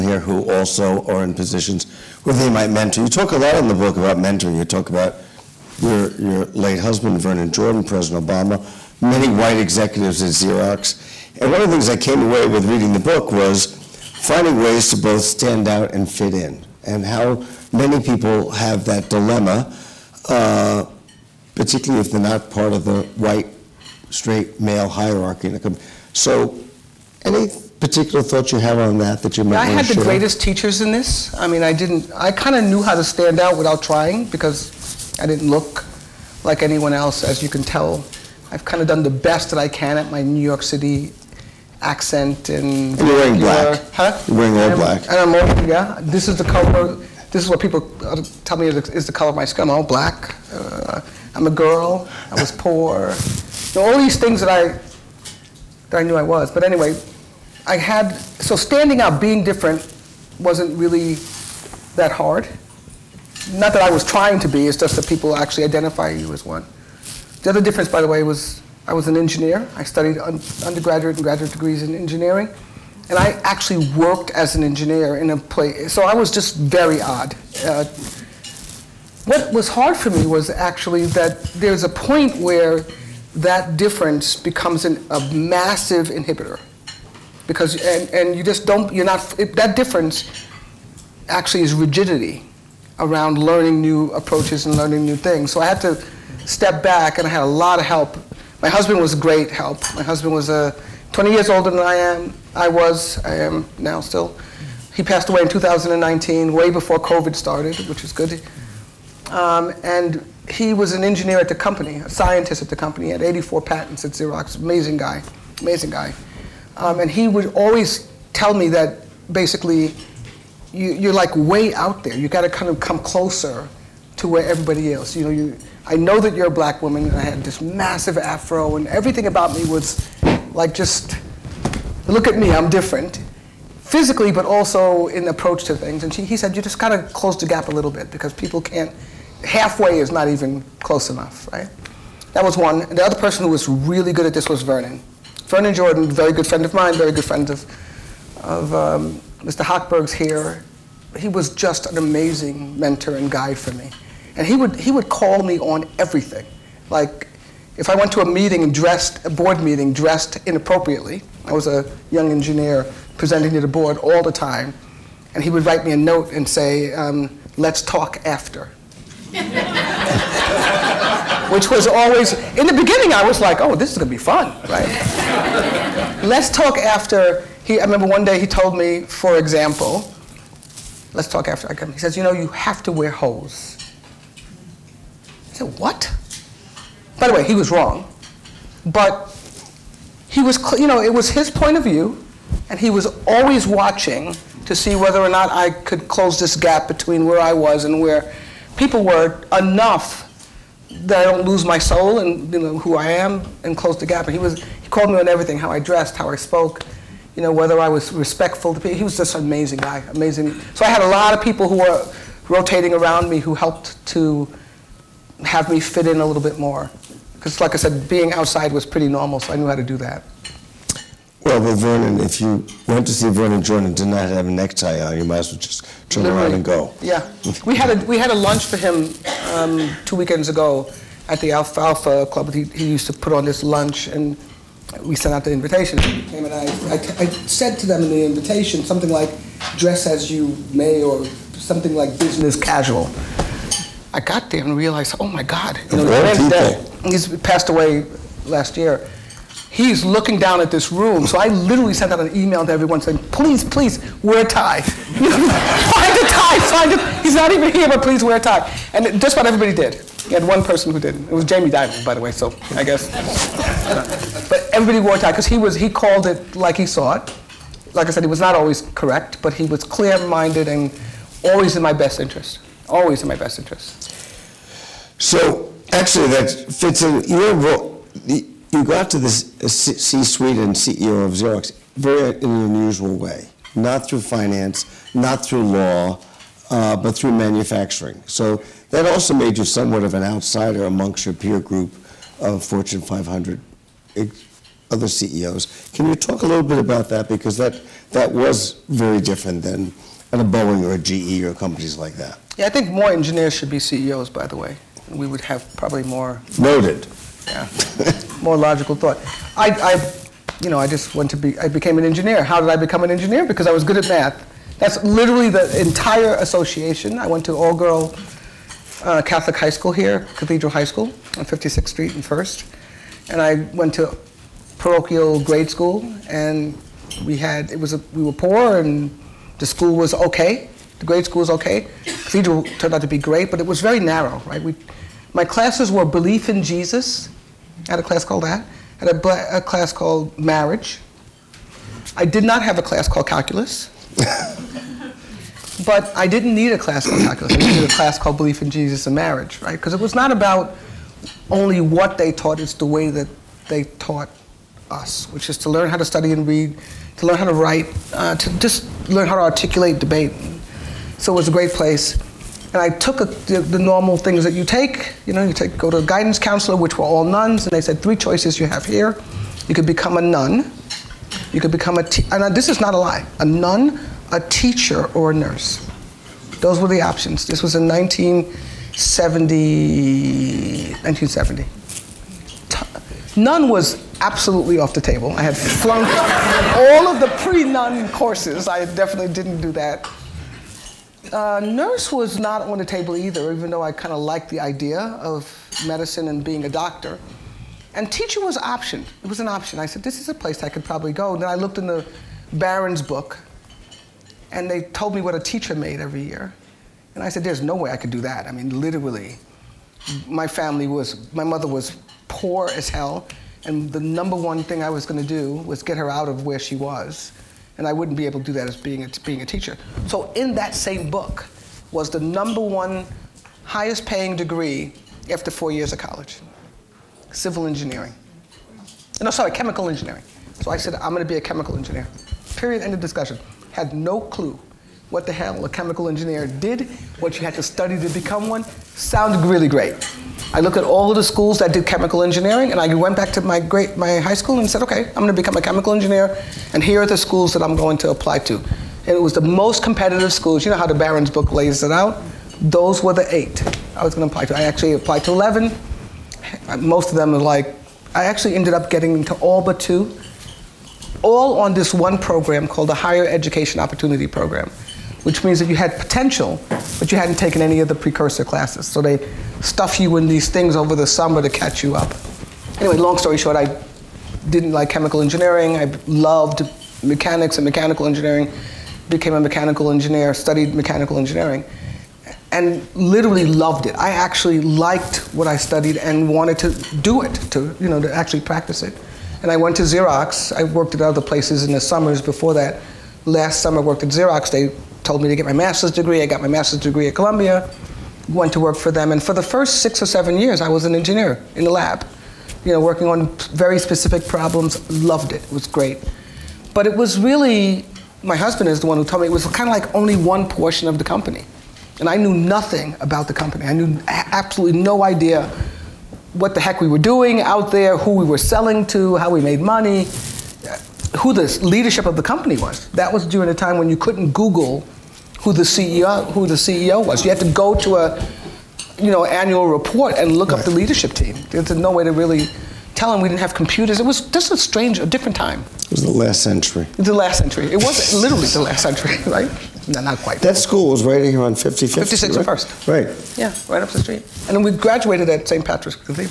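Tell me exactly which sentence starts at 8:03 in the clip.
I actually liked what I studied and wanted to do it, to, you know, to actually practice it.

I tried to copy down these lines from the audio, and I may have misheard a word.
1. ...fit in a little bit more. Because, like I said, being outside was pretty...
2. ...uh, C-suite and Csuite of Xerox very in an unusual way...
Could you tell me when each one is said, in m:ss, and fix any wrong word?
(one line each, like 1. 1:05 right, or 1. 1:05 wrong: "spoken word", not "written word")
1. 3:35 right
2. 4:39 wrong: "CEO", not "Csuite".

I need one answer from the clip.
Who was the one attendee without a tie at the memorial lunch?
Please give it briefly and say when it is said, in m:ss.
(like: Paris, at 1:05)
Jamie Dimon, at 4:21.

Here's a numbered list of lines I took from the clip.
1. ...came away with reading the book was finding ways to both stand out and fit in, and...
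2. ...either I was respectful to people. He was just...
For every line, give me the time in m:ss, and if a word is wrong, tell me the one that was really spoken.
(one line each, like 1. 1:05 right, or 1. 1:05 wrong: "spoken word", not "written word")
1. 0:11 right
2. 3:27 wrong: "whether", not "either".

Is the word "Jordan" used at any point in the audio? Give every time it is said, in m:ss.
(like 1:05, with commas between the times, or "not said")
0:07, 2:25, 3:43.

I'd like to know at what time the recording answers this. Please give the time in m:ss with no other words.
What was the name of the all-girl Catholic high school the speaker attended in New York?
5:20.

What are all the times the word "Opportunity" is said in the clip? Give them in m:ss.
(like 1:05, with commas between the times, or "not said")
7:43.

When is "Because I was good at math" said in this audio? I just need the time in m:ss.
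5:13.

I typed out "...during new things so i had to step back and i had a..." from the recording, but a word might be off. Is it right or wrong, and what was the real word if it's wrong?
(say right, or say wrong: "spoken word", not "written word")
wrong: "learning", not "during".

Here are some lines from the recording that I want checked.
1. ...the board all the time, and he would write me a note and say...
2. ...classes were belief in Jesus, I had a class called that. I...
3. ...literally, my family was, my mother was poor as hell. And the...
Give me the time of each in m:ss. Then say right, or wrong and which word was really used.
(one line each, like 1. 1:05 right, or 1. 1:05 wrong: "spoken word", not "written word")
1. 2:43 right
2. 5:35 right
3. 6:48 right.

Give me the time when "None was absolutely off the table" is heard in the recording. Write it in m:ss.
6:23.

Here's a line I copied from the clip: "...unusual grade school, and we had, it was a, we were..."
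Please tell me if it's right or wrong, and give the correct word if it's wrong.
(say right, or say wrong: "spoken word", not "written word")
wrong: "parochial", not "unusual".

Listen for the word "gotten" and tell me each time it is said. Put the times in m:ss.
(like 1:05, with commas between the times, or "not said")
not said.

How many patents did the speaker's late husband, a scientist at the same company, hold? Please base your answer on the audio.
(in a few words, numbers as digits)
84.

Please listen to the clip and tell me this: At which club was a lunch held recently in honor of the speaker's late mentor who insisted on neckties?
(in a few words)
Alfalfa Club.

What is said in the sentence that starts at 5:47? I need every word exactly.
I needed a class called belief in Jesus and marriage, right?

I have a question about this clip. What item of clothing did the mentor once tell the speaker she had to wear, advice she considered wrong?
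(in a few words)
Hose.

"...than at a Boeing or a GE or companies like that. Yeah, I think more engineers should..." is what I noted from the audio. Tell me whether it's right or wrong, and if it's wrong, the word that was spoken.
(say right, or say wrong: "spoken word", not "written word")
right.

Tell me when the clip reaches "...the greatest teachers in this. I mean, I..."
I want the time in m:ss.
0:29.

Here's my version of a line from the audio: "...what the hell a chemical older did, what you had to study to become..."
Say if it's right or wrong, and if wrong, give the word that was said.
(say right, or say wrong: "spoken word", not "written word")
wrong: "engineer", not "older".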